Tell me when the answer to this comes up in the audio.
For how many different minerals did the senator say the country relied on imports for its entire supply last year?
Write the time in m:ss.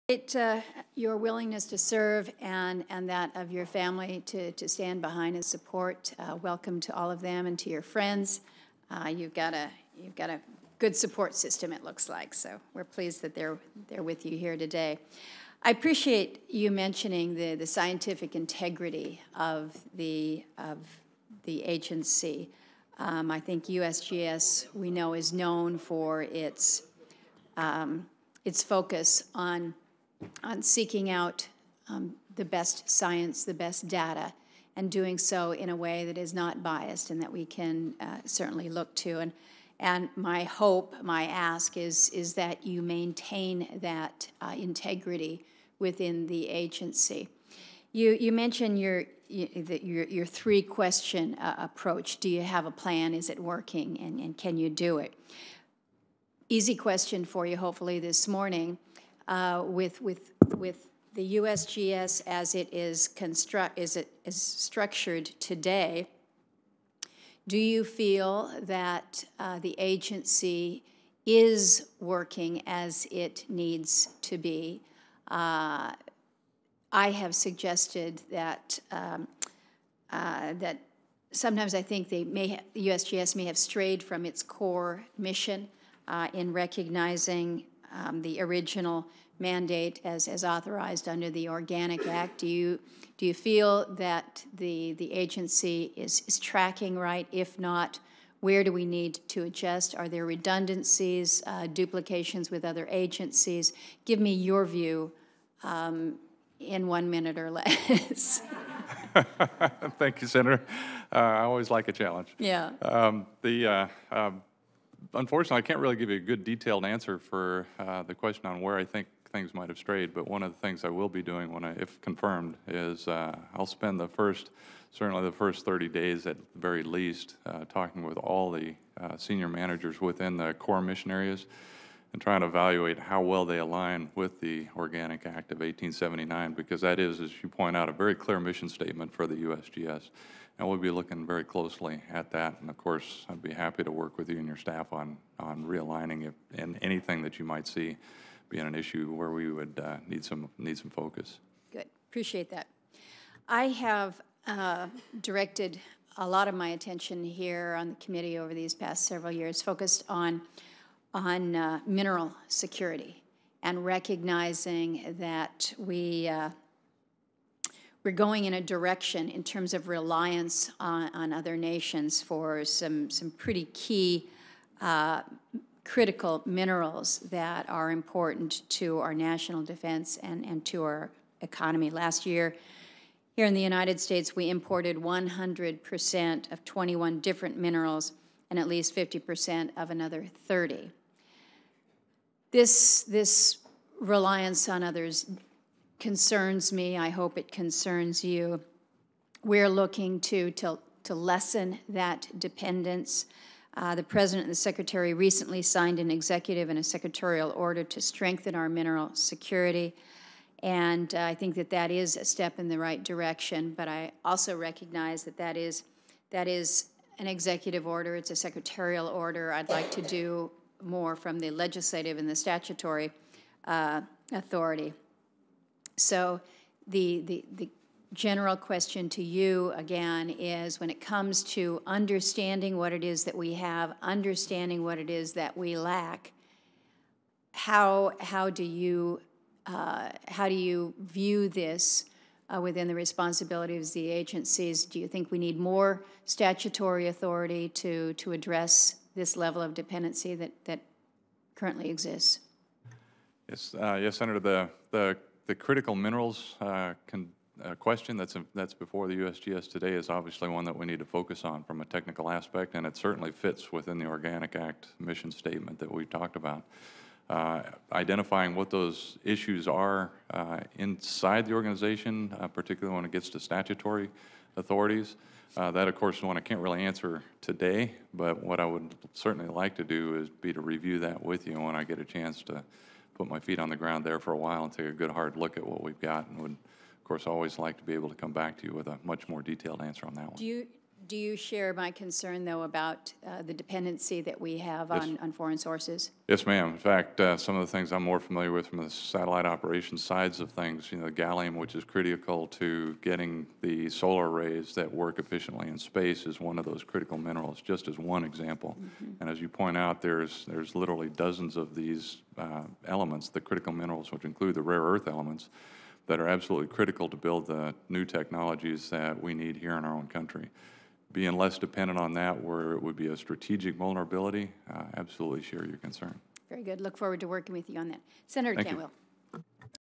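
3:06.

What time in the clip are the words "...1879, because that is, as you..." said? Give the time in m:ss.
2:15.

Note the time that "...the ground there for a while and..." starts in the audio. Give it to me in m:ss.
4:43.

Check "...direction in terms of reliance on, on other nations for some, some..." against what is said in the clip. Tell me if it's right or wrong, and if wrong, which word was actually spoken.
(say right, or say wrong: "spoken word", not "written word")
right.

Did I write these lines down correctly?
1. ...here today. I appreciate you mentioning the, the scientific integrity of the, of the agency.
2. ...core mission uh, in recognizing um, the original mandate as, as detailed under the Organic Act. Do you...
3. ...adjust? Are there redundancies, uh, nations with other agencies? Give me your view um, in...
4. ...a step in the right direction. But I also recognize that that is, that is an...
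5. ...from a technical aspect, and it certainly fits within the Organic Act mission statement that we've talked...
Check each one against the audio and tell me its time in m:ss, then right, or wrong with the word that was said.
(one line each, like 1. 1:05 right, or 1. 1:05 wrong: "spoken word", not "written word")
1. 0:14 right
2. 1:24 wrong: "authorized", not "detailed"
3. 1:39 wrong: "duplications", not "nations"
4. 3:32 right
5. 4:21 right.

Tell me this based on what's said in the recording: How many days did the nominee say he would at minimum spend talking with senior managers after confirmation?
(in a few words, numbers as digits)
30.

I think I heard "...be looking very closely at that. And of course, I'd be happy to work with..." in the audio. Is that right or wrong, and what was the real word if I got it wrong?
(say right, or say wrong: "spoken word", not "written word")
right.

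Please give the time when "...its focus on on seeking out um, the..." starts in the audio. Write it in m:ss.
0:28.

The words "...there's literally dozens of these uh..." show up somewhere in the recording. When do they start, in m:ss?
5:10.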